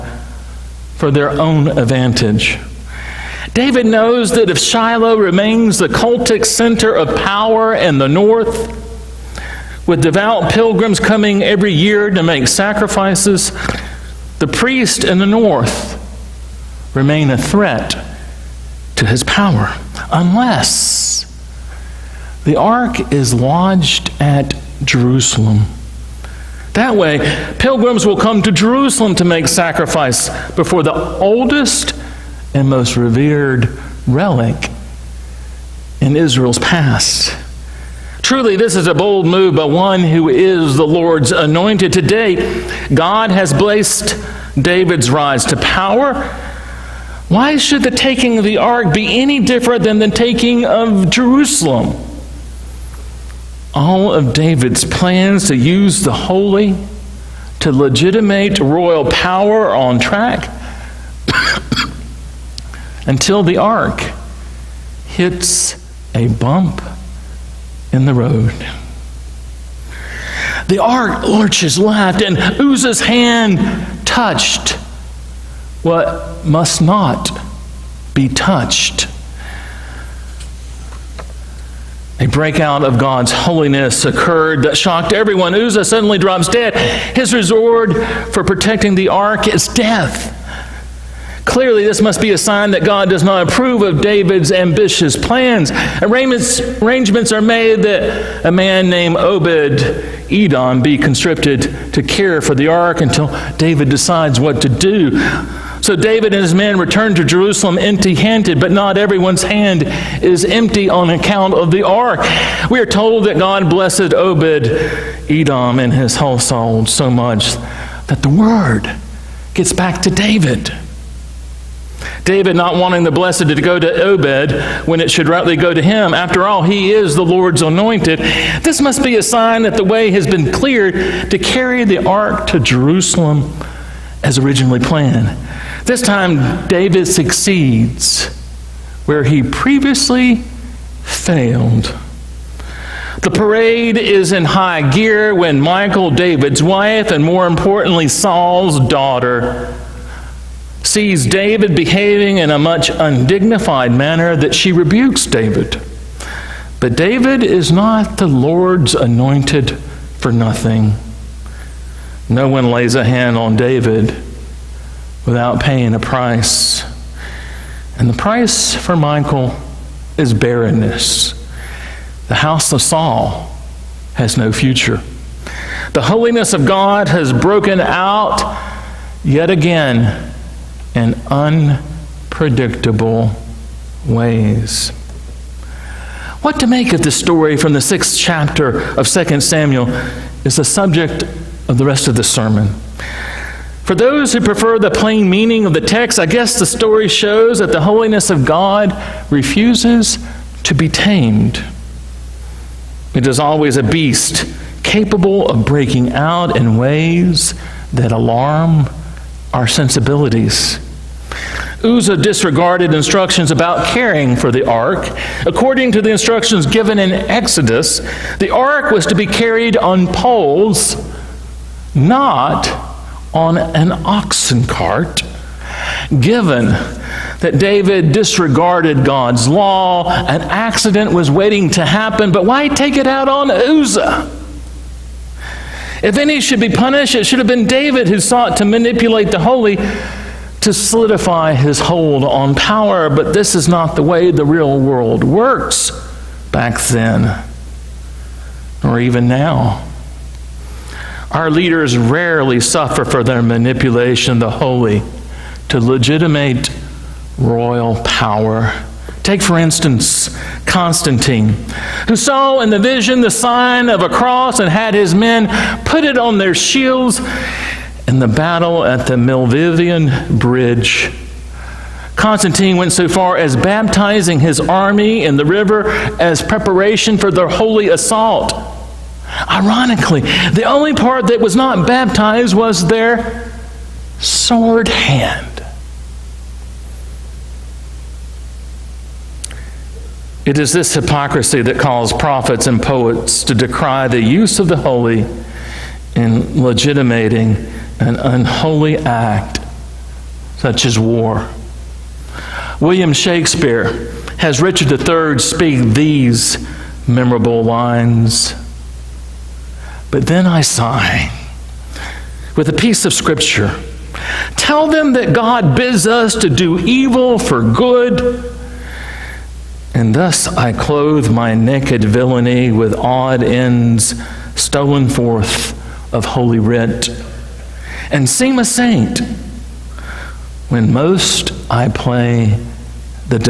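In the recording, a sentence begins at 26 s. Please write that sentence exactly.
That way, pilgrims will come to Jerusalem to make sacrifice before the oldest and most revered relic in Israel's past.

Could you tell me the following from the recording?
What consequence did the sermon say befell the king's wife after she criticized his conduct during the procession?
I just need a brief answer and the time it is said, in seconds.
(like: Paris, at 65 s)
Barrenness, at 170 s.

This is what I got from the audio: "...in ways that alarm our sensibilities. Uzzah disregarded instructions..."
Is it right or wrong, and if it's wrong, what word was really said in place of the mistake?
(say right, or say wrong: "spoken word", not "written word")
right.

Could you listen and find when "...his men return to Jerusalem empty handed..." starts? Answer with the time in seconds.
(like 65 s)
106 s.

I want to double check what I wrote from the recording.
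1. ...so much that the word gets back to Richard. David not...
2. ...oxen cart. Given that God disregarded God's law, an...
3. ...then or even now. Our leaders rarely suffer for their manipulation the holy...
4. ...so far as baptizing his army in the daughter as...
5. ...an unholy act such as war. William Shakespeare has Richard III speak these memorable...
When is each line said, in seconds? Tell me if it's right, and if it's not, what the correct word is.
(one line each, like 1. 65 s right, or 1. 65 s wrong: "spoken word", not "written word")
1. 116 s wrong: "David", not "Richard"
2. 223 s wrong: "David", not "God"
3. 246 s right
4. 272 s wrong: "river", not "daughter"
5. 298 s right.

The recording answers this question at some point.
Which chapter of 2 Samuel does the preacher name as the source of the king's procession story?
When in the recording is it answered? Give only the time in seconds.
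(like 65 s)
187 s.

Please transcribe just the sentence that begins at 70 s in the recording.
The ark lurches left, and Uzzah's hand touched what must not be touched.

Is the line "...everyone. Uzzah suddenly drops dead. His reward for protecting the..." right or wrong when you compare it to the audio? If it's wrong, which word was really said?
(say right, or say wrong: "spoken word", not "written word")
right.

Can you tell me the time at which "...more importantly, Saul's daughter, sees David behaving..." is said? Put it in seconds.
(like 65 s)
147 s.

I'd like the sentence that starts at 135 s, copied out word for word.
This time, David succeeds where he previously failed.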